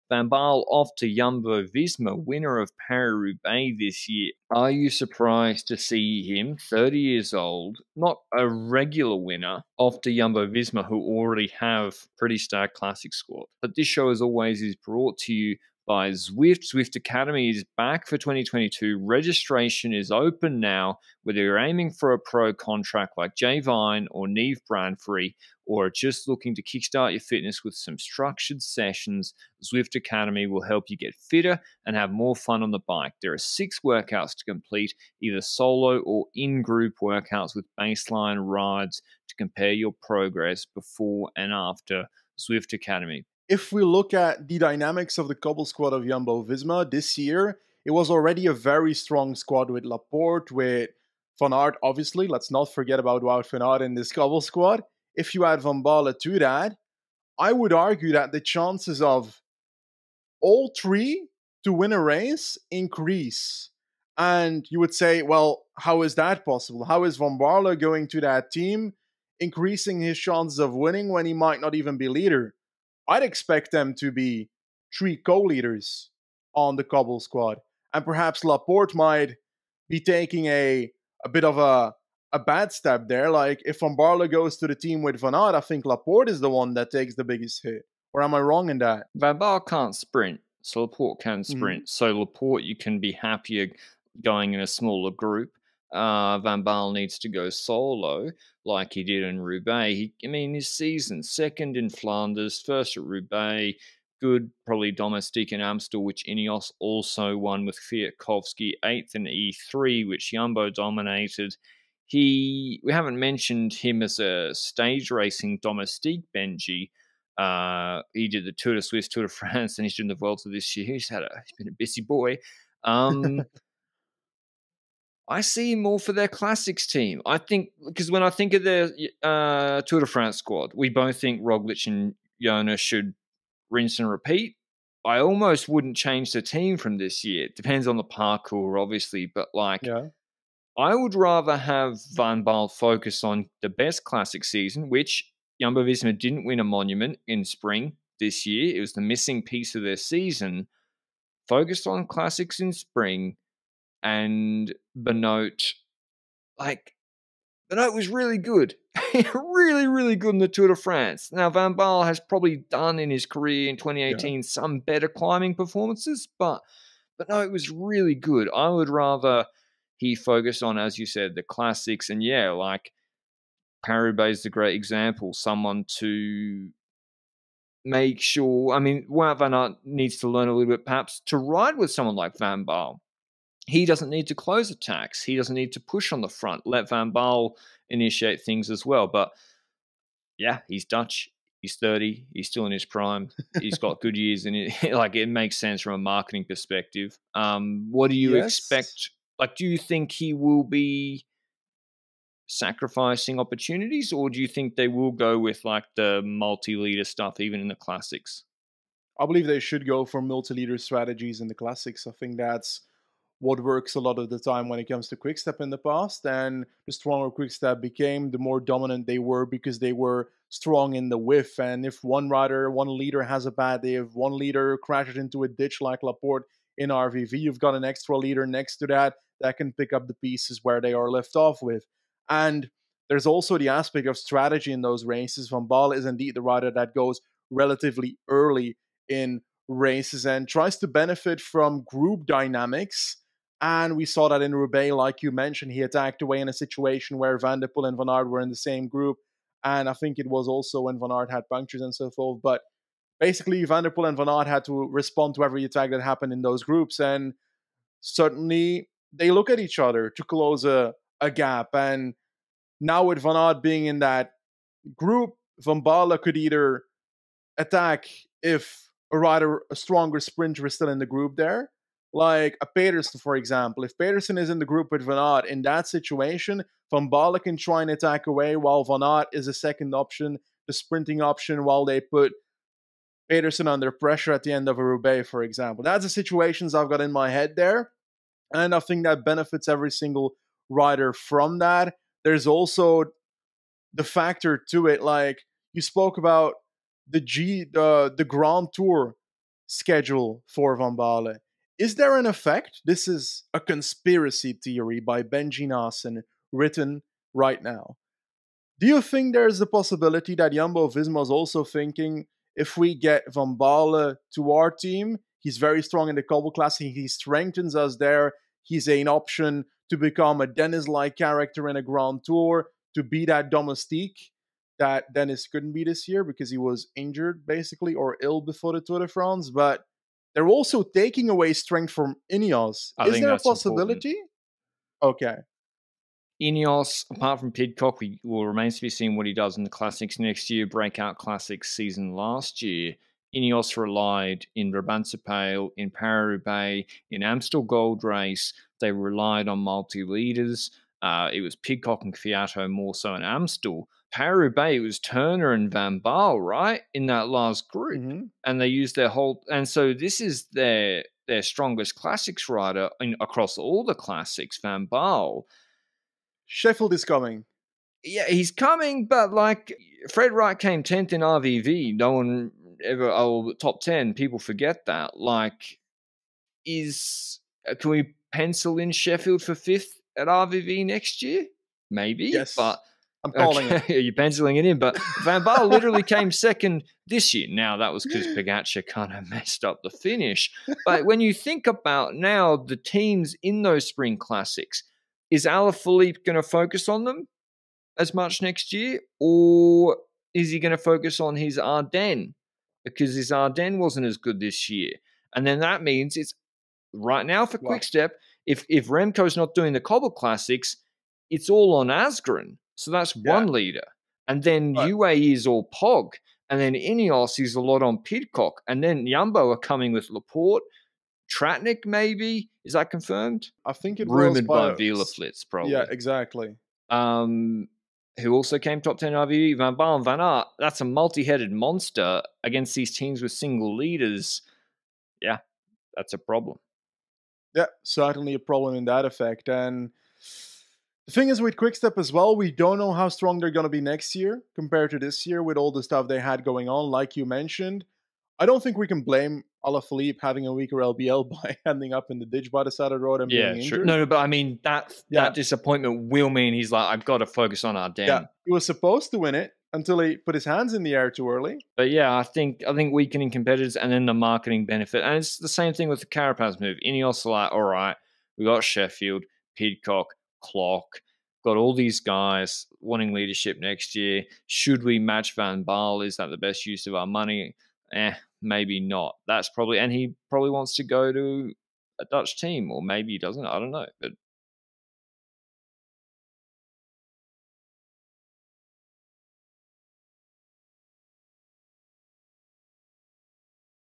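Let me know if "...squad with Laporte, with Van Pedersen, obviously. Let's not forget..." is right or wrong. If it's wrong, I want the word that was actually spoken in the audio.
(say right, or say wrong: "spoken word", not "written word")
wrong: "Aert", not "Pedersen".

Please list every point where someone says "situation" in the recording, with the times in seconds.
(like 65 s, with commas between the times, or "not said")
246 s, 275 s, 286 s.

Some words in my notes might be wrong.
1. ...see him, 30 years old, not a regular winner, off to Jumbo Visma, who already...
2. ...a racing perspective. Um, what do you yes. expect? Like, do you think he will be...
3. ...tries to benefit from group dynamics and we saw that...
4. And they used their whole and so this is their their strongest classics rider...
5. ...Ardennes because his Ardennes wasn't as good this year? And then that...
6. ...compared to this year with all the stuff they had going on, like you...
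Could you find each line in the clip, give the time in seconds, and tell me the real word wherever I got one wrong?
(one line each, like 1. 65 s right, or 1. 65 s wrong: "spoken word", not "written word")
1. 5 s right
2. 195 s wrong: "marketing", not "racing"
3. 240 s right
4. 358 s right
5. 401 s right
6. 444 s right.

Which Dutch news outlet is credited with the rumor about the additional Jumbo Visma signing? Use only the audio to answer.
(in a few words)
WielerFlits.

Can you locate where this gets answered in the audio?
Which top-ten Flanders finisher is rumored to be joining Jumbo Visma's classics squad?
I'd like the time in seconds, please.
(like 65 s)
421 s.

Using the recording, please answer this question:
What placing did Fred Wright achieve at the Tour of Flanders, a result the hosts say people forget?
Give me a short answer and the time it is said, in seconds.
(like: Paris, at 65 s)
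10th, at 370 s.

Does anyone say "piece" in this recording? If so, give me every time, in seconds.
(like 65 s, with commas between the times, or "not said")
149 s, 230 s.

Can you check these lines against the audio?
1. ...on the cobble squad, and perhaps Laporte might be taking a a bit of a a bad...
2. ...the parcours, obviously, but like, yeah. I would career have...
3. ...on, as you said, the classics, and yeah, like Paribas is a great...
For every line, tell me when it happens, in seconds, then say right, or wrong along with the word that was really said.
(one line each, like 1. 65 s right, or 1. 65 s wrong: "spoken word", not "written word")
1. 76 s right
2. 137 s wrong: "rather", not "career"
3. 170 s right.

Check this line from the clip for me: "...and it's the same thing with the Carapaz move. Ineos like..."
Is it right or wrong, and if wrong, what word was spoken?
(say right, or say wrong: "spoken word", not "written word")
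right.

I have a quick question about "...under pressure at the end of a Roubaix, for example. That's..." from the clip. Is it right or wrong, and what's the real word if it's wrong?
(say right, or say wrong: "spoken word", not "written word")
right.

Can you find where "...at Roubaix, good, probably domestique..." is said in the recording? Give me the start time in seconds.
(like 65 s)
102 s.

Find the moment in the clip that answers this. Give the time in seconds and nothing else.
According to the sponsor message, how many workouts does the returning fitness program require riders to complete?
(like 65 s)
33 s.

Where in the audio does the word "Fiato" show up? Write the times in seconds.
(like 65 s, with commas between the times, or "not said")
352 s.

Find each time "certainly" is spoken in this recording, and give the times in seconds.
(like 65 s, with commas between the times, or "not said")
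257 s, 437 s.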